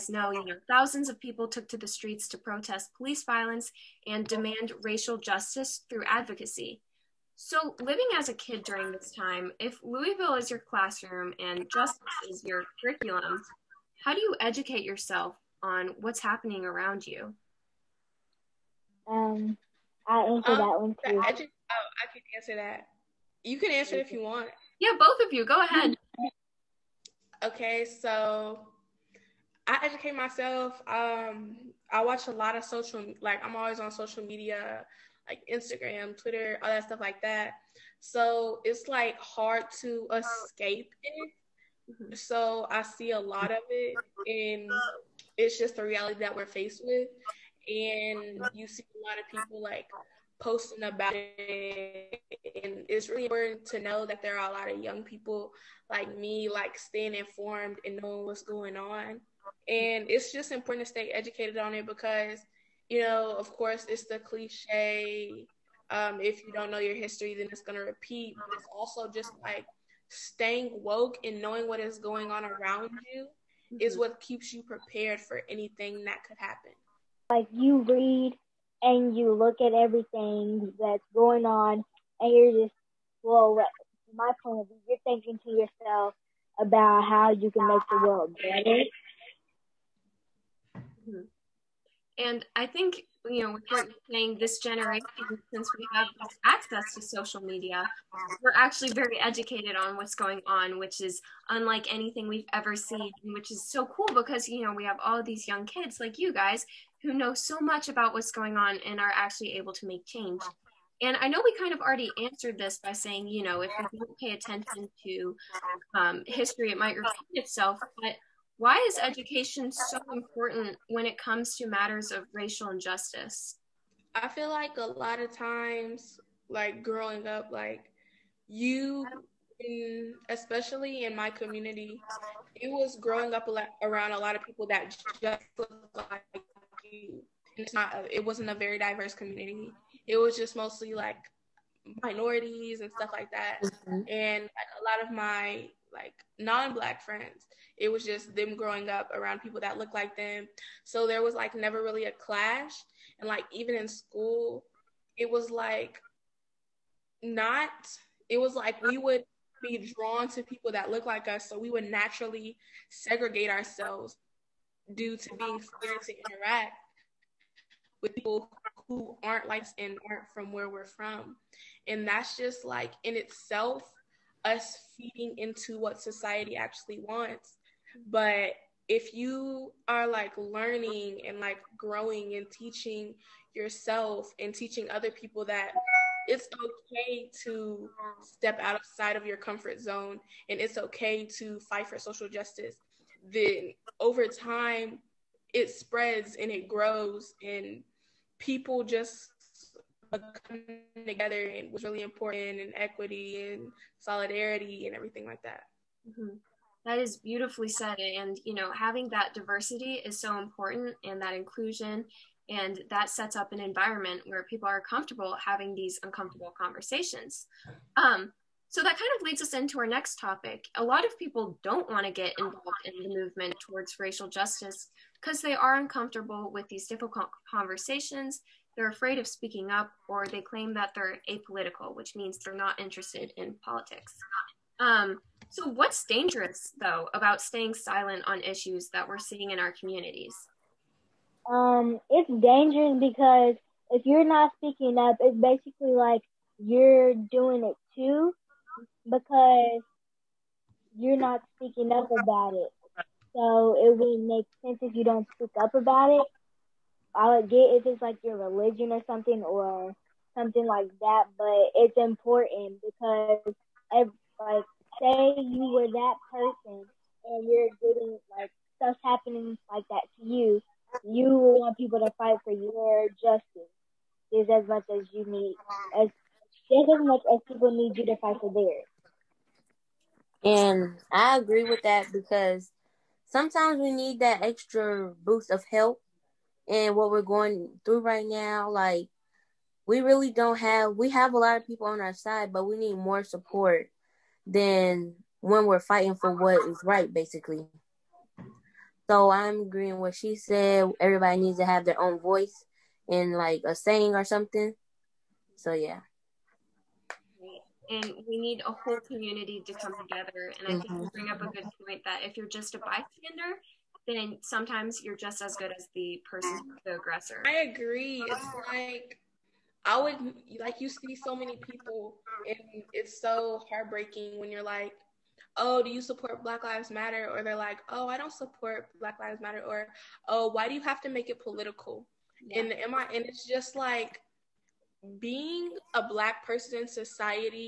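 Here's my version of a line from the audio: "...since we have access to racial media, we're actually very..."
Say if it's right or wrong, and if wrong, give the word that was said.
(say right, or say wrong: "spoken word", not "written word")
wrong: "social", not "racial".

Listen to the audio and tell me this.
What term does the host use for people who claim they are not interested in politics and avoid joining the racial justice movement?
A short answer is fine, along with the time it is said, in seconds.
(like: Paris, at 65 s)
apolitical, at 231 s.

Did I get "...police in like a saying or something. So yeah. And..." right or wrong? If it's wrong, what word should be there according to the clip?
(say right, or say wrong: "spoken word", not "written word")
wrong: "voice", not "police".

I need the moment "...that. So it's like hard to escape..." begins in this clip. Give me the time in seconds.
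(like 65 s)
37 s.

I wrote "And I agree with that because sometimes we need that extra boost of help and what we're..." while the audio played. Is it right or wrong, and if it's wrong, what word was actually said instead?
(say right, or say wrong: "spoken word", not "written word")
right.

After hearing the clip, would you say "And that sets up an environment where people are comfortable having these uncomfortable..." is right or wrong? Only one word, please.
right.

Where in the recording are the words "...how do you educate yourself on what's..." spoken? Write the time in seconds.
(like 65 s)
14 s.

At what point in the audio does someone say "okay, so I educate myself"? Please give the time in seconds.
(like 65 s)
27 s.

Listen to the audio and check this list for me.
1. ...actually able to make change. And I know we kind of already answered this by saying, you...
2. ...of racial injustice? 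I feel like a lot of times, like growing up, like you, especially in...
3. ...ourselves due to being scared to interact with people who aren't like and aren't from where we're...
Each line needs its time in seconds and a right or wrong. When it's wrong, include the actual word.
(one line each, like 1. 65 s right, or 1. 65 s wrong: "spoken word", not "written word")
1. 109 s right
2. 122 s right
3. 163 s right.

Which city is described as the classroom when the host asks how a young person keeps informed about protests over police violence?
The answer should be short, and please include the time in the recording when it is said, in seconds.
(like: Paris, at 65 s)
Louisville, at 9 s.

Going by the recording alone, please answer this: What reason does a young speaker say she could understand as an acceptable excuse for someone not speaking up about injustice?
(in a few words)
religion.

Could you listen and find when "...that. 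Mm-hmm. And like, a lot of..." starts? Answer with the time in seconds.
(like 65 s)
143 s.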